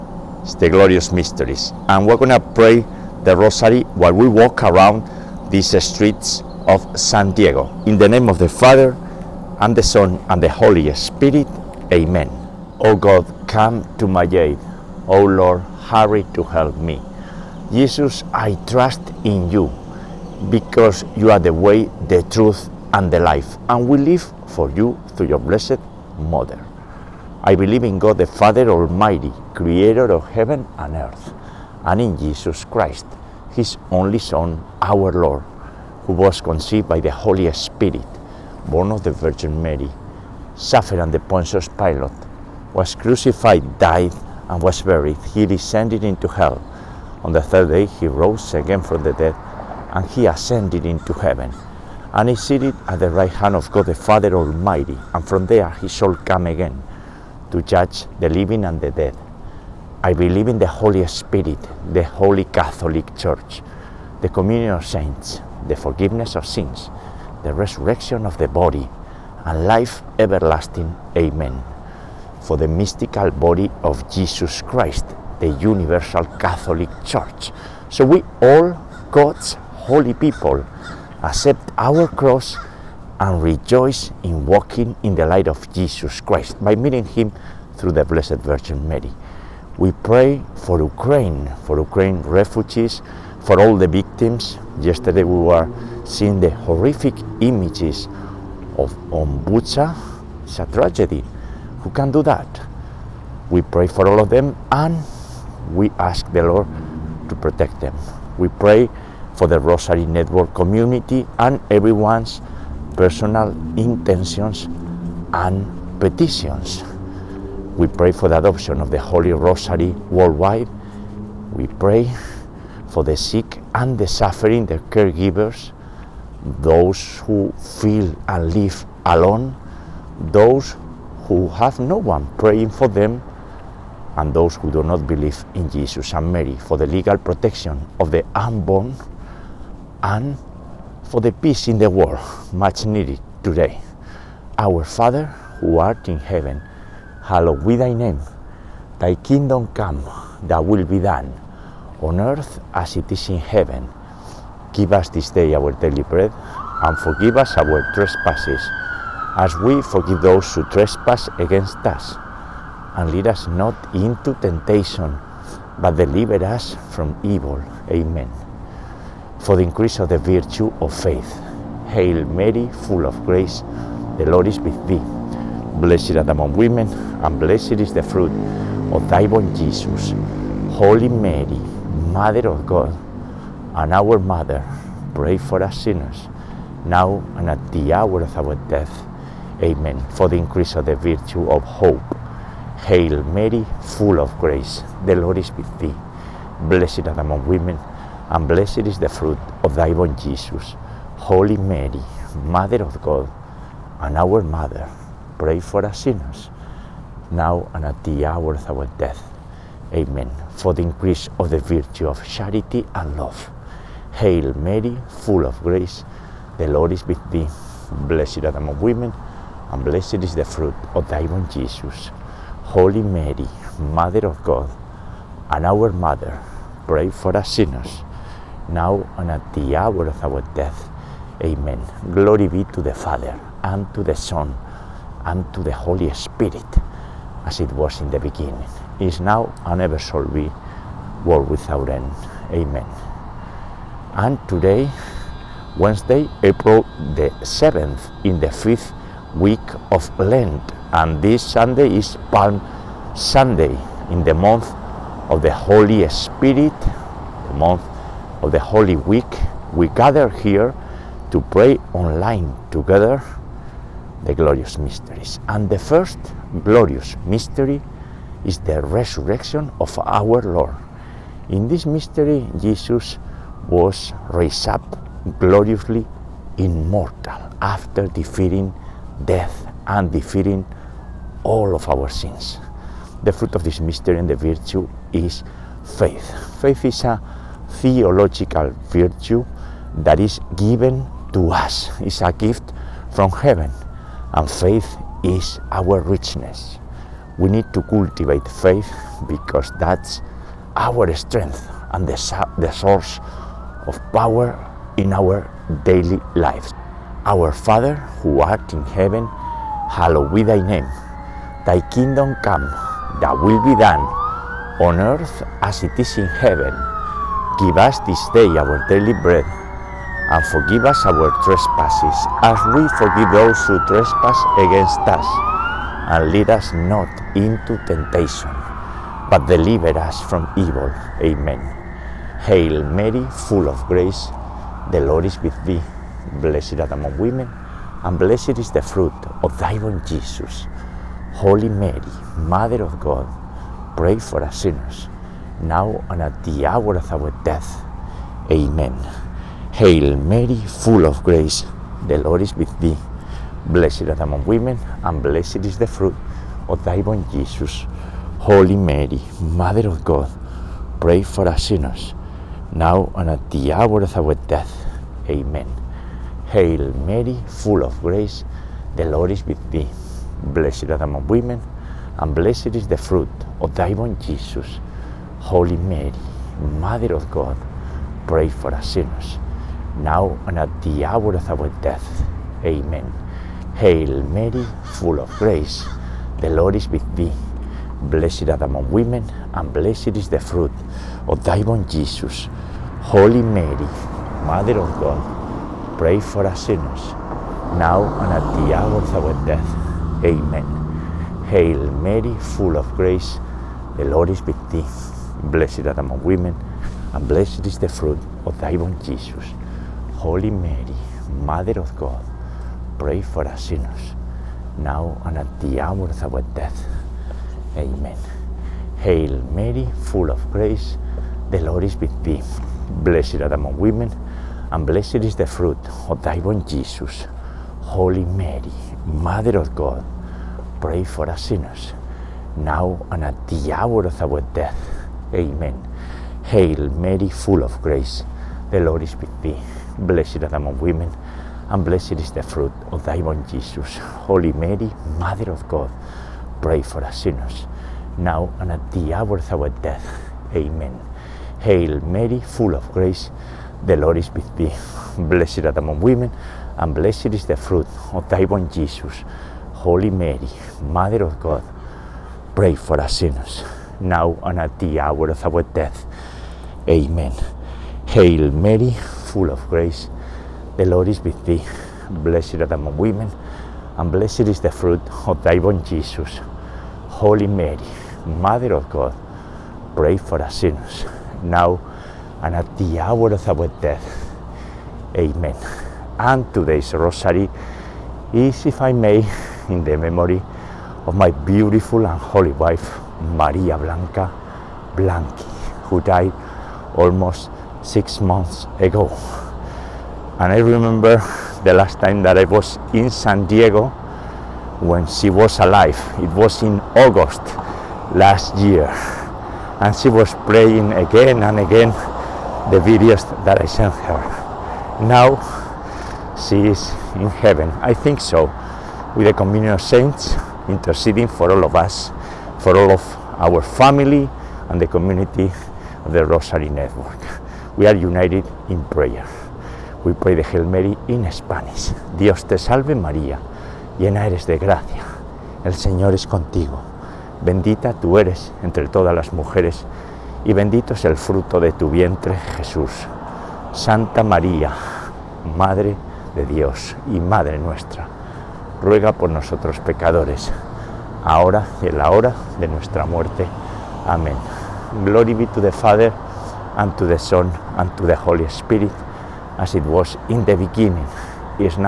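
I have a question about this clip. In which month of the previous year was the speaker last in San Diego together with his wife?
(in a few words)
August.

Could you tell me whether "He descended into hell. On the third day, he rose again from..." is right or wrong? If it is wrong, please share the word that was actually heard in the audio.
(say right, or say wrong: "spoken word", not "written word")
right.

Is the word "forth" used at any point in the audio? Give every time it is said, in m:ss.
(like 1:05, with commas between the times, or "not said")
not said.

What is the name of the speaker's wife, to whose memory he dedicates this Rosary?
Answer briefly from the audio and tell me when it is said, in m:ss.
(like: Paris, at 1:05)
Maria Blanca, at 8:13.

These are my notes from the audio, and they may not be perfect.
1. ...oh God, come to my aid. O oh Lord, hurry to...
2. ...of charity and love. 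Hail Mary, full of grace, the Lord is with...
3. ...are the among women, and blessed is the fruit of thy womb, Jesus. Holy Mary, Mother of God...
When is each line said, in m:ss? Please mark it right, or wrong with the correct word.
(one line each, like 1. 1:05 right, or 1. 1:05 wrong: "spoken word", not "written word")
1. 0:12 right
2. 3:32 right
3. 7:52 right.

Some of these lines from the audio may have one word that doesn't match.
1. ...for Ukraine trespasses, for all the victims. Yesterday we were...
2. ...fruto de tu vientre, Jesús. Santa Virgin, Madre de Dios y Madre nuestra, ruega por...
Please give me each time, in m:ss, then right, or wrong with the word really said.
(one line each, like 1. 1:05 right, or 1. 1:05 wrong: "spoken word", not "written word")
1. 1:31 wrong: "refugees", not "trespasses"
2. 9:01 wrong: "María", not "Virgin".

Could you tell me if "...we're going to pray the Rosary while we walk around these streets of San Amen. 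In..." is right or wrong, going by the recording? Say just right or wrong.
wrong.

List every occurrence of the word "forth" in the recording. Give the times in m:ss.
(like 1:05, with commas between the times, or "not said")
not said.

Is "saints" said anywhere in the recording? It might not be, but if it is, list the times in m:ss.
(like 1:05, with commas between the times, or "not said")
1:04, 8:39.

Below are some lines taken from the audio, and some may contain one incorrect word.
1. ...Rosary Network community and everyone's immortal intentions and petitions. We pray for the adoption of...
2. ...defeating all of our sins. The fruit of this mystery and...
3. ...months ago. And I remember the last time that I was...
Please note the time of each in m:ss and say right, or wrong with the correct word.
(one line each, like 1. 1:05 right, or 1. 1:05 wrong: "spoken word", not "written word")
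1. 1:49 wrong: "personal", not "immortal"
2. 4:40 right
3. 8:18 right.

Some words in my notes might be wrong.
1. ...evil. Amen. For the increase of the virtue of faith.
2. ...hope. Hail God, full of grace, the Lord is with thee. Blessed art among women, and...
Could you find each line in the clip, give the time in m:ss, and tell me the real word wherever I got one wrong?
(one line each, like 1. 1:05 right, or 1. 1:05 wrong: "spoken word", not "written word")
1. 2:47 right
2. 3:11 wrong: "Mary", not "God".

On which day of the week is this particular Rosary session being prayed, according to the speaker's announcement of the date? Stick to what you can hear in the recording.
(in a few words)
Wednesday.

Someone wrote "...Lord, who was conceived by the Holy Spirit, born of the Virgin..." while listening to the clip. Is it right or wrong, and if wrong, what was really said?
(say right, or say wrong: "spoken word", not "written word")
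right.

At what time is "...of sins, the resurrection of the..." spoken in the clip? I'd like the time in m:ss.
1:06.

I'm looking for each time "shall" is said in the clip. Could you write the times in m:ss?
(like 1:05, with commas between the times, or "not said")
0:55, 3:59.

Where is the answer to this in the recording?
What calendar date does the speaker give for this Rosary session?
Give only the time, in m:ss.
4:06.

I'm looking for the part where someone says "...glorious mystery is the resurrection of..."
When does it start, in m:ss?
4:26.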